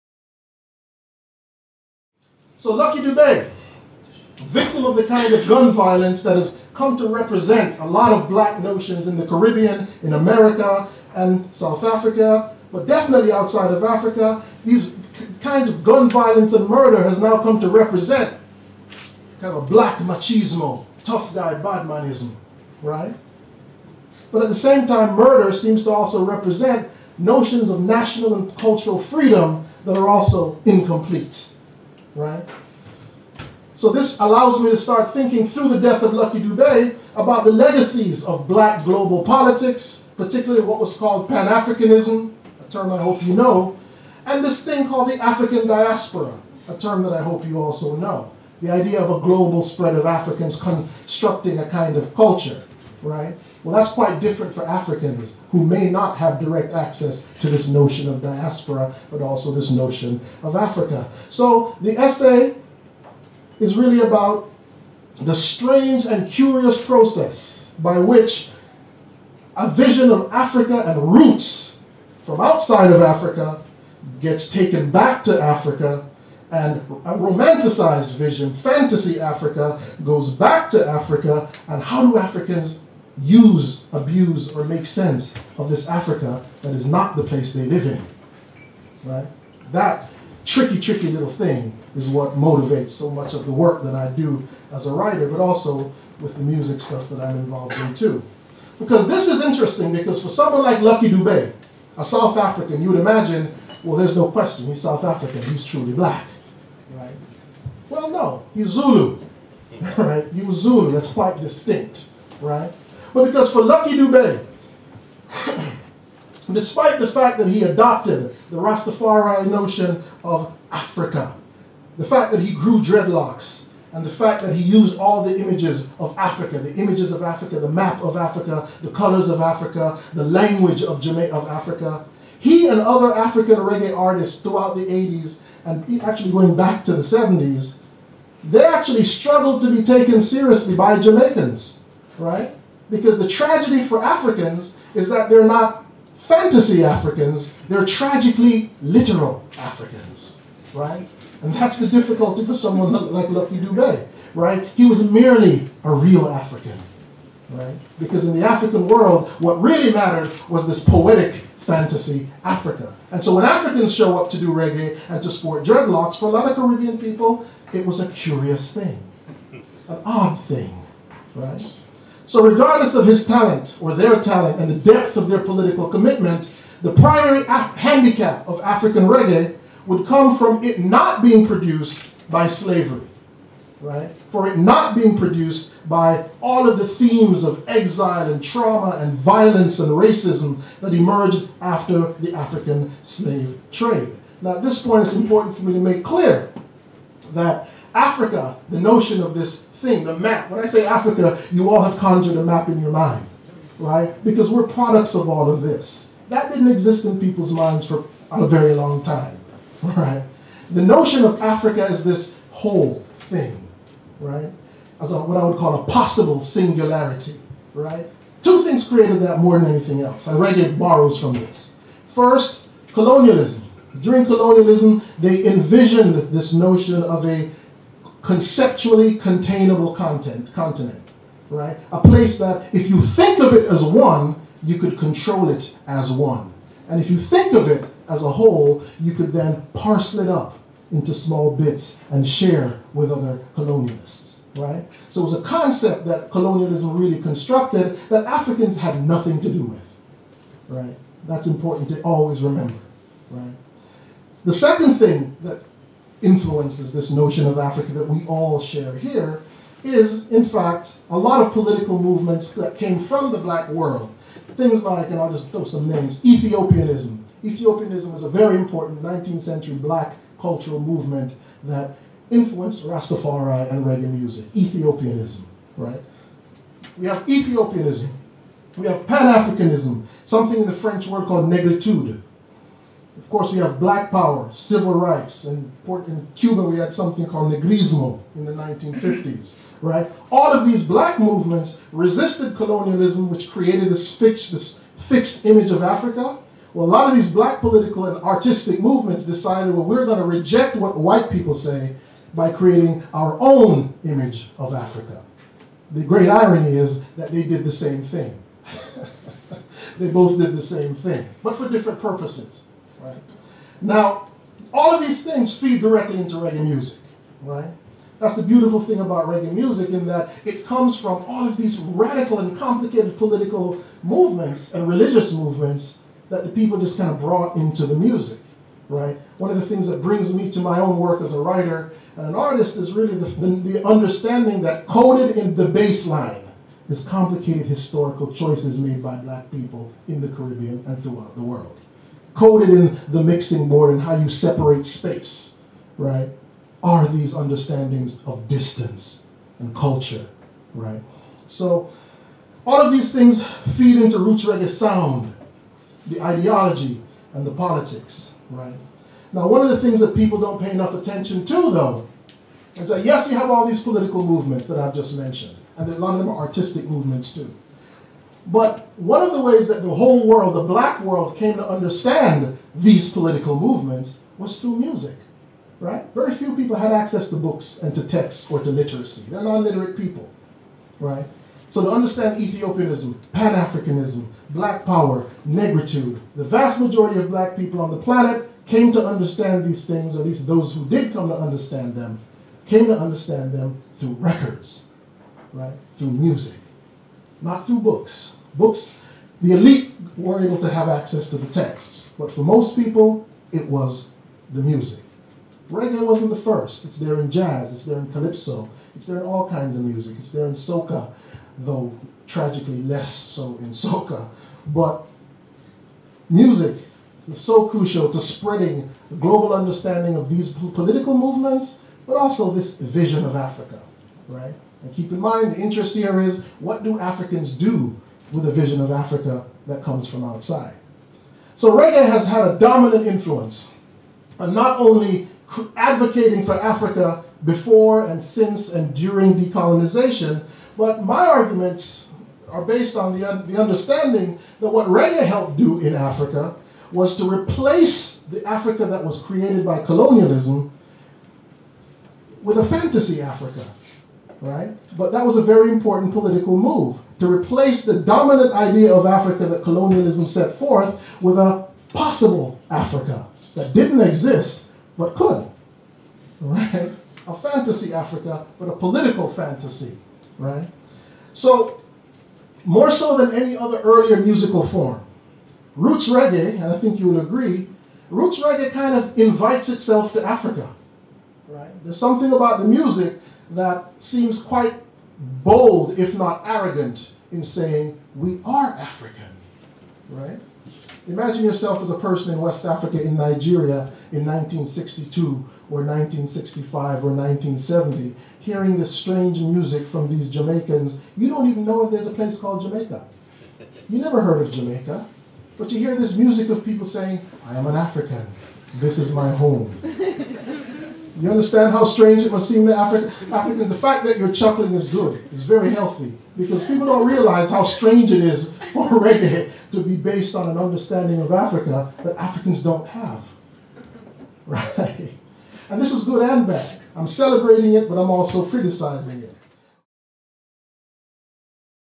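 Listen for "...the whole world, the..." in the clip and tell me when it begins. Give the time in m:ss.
6:09.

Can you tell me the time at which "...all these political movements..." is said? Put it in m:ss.
6:03.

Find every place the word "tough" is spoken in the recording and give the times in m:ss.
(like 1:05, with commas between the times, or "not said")
0:21.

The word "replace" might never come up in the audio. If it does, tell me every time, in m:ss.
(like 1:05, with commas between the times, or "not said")
7:27, 7:37.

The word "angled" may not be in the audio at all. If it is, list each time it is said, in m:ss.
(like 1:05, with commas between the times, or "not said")
not said.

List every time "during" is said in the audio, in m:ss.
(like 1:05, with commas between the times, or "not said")
3:44, 7:18.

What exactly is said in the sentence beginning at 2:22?
because the tragedy for Africans is that they're not fantasy Africans, they're tragically literal Africans, right?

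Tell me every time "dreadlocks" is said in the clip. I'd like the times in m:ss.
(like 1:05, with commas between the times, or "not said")
2:02, 2:45.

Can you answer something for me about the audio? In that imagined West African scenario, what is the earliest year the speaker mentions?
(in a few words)
1962.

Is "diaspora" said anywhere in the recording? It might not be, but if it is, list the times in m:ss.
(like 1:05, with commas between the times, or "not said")
0:45, 0:58.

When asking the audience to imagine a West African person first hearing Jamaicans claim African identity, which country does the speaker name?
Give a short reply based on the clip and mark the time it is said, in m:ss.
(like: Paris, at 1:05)
Nigeria, at 8:13.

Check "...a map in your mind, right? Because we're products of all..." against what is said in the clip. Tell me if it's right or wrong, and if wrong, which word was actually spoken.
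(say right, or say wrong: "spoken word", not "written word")
right.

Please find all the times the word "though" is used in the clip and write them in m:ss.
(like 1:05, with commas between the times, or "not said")
6:01, 6:51.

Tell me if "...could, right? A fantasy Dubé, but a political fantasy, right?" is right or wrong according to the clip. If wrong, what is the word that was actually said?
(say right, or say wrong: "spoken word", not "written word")
wrong: "Africa", not "Dubé".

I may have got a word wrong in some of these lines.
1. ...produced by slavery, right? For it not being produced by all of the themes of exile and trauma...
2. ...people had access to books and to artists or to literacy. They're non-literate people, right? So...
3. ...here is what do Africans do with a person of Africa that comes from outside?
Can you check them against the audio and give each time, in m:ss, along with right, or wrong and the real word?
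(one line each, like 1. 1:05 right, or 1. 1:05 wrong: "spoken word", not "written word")
1. 3:01 right
2. 6:16 wrong: "texts", not "artists"
3. 7:05 wrong: "vision", not "person".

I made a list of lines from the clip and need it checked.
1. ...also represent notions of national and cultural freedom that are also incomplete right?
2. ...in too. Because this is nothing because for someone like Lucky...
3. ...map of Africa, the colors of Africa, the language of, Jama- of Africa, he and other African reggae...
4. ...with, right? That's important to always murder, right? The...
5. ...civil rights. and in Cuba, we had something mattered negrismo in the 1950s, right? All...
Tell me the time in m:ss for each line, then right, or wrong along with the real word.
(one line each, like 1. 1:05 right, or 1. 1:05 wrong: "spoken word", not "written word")
1. 0:25 right
2. 1:37 wrong: "interesting", not "nothing"
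3. 2:07 right
4. 4:09 wrong: "remember", not "murder"
5. 4:44 wrong: "called", not "mattered".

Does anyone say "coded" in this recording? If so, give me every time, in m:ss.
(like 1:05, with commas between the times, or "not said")
5:34, 5:42.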